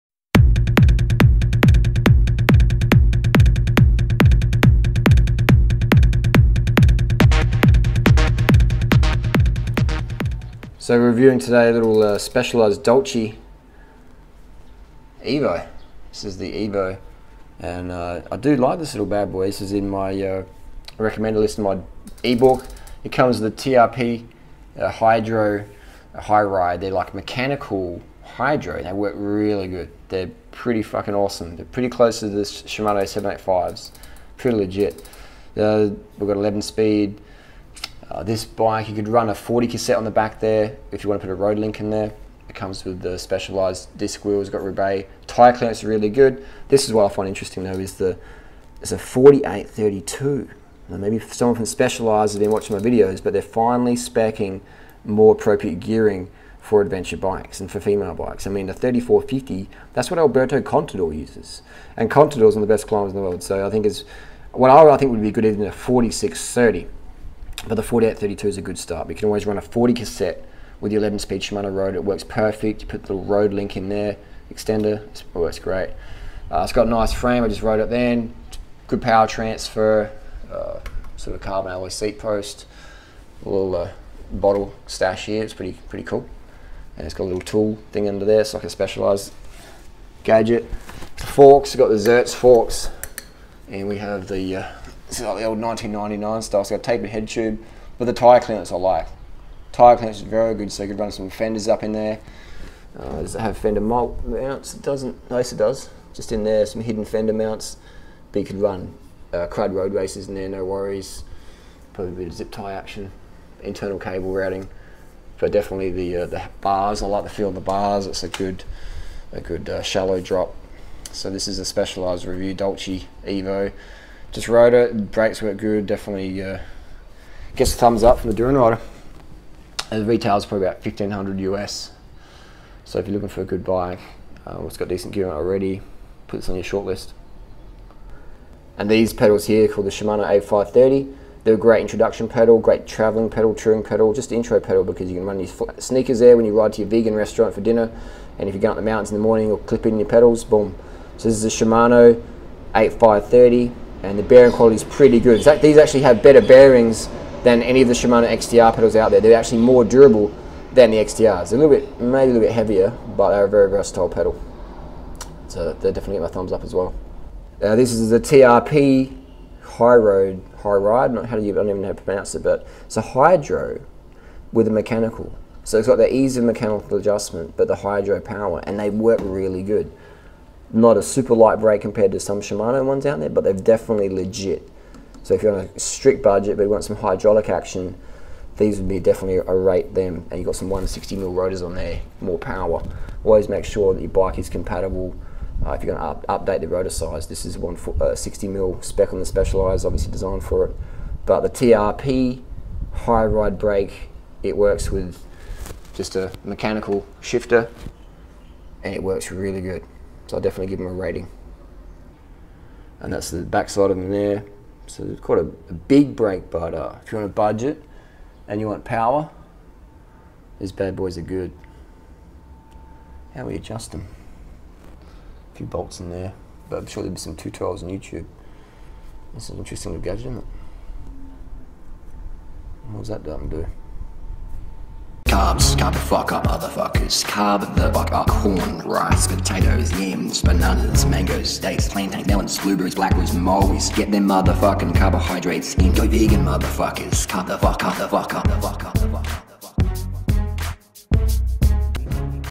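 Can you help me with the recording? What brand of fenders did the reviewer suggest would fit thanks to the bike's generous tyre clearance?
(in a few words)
Crud Roadracers.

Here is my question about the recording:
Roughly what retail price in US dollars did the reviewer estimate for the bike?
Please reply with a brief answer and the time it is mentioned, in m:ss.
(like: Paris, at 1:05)
1500, at 2:10.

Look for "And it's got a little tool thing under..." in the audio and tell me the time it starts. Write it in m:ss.
1:26.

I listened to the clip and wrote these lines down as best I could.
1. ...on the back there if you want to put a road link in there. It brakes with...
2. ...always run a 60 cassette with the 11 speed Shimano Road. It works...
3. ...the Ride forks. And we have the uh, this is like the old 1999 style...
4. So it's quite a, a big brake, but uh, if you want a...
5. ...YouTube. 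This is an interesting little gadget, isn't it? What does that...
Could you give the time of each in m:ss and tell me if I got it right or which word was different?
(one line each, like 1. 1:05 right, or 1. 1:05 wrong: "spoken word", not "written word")
1. 0:39 wrong: "comes", not "brakes"
2. 1:09 wrong: "40", not "60"
3. 1:31 wrong: "Zertz", not "Ride"
4. 3:34 right
5. 3:47 right.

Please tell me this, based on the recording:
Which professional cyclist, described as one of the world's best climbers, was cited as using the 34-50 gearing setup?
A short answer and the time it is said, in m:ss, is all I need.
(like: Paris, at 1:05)
Alberto Contador, at 1:00.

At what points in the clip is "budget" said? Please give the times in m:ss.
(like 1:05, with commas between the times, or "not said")
3:06, 3:37.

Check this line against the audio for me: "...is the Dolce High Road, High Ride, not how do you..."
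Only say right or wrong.
wrong.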